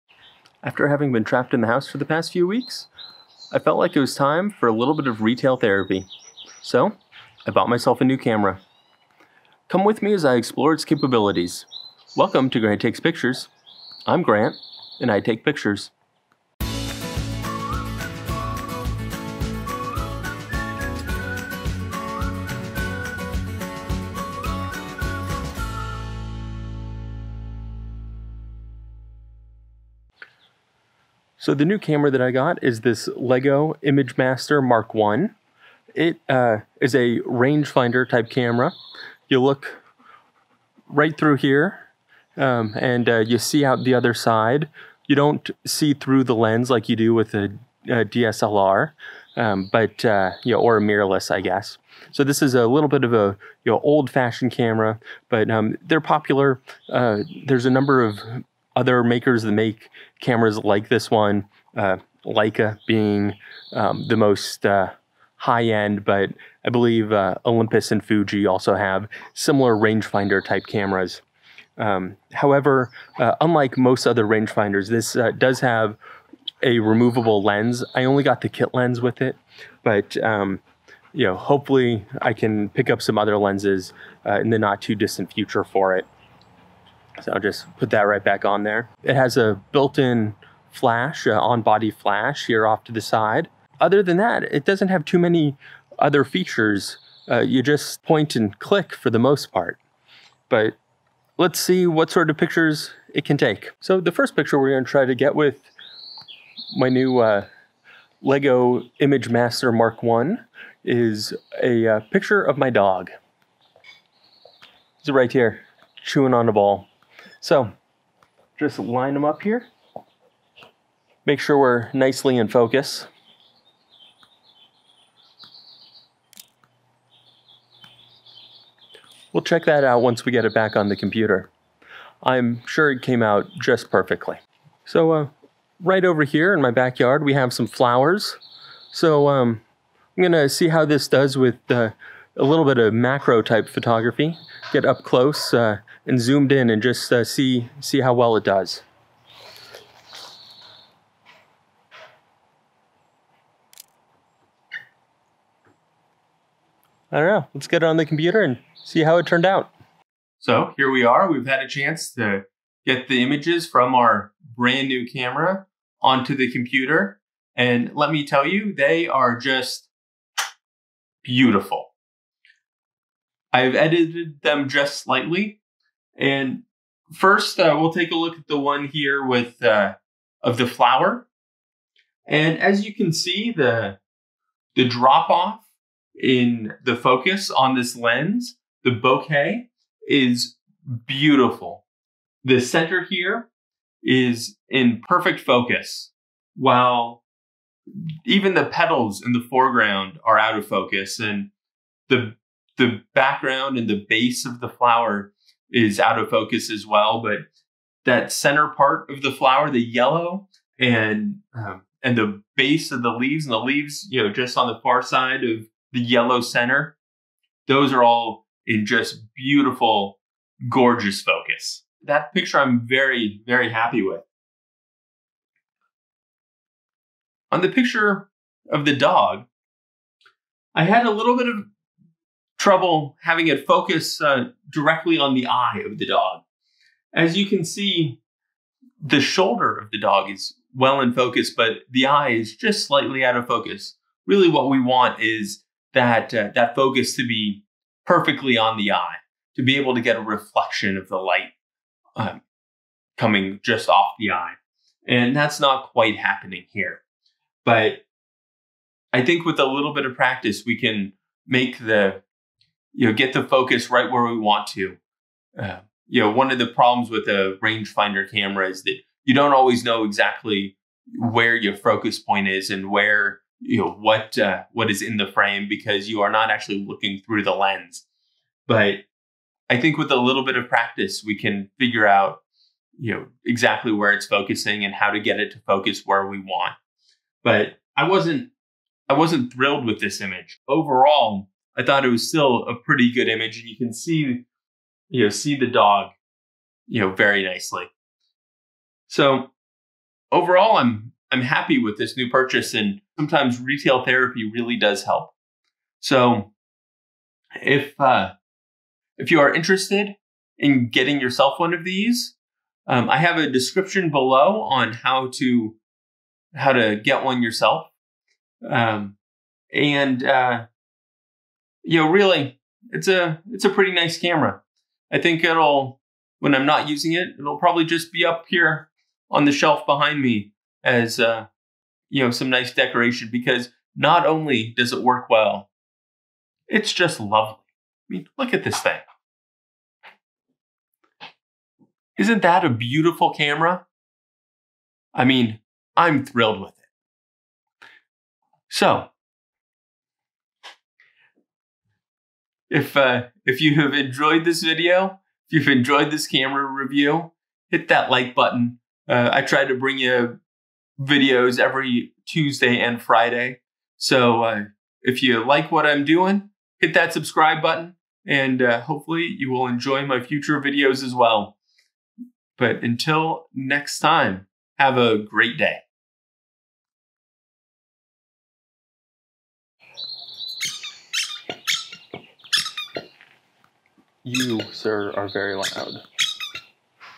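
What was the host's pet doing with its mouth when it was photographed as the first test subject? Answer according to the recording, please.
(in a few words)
chewing on a ball.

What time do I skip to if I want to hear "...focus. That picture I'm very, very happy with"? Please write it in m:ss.
3:41.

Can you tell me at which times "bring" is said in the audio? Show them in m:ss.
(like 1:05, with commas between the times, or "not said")
5:59.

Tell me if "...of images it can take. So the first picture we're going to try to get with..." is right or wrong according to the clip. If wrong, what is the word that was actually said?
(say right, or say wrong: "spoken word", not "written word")
wrong: "pictures", not "images".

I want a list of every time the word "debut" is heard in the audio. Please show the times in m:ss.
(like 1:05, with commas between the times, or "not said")
not said.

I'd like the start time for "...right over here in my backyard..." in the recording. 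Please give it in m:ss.
2:15.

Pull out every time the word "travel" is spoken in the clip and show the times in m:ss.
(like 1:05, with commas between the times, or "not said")
not said.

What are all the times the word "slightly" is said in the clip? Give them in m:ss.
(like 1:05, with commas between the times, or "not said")
2:55, 4:02.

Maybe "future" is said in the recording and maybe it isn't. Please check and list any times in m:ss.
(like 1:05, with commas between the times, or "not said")
1:25, 6:10.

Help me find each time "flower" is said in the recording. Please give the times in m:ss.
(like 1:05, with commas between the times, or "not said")
2:17, 3:00, 3:24, 3:29.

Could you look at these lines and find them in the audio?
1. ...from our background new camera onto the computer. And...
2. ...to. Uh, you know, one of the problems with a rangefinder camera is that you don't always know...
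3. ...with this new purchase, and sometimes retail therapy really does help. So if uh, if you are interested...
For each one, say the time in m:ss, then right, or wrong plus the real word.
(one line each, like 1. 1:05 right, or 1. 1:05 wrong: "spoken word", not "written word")
1. 2:43 wrong: "brand", not "background"
2. 4:24 right
3. 5:01 right.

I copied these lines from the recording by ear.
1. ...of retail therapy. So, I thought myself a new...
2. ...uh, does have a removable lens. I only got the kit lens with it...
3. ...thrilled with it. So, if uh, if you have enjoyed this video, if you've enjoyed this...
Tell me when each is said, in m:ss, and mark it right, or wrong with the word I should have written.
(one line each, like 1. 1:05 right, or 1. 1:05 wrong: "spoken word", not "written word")
1. 0:05 wrong: "bought", not "thought"
2. 1:15 right
3. 5:46 right.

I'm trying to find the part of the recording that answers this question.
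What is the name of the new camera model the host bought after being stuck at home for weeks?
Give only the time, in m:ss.
0:33.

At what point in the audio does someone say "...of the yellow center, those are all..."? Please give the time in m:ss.
3:35.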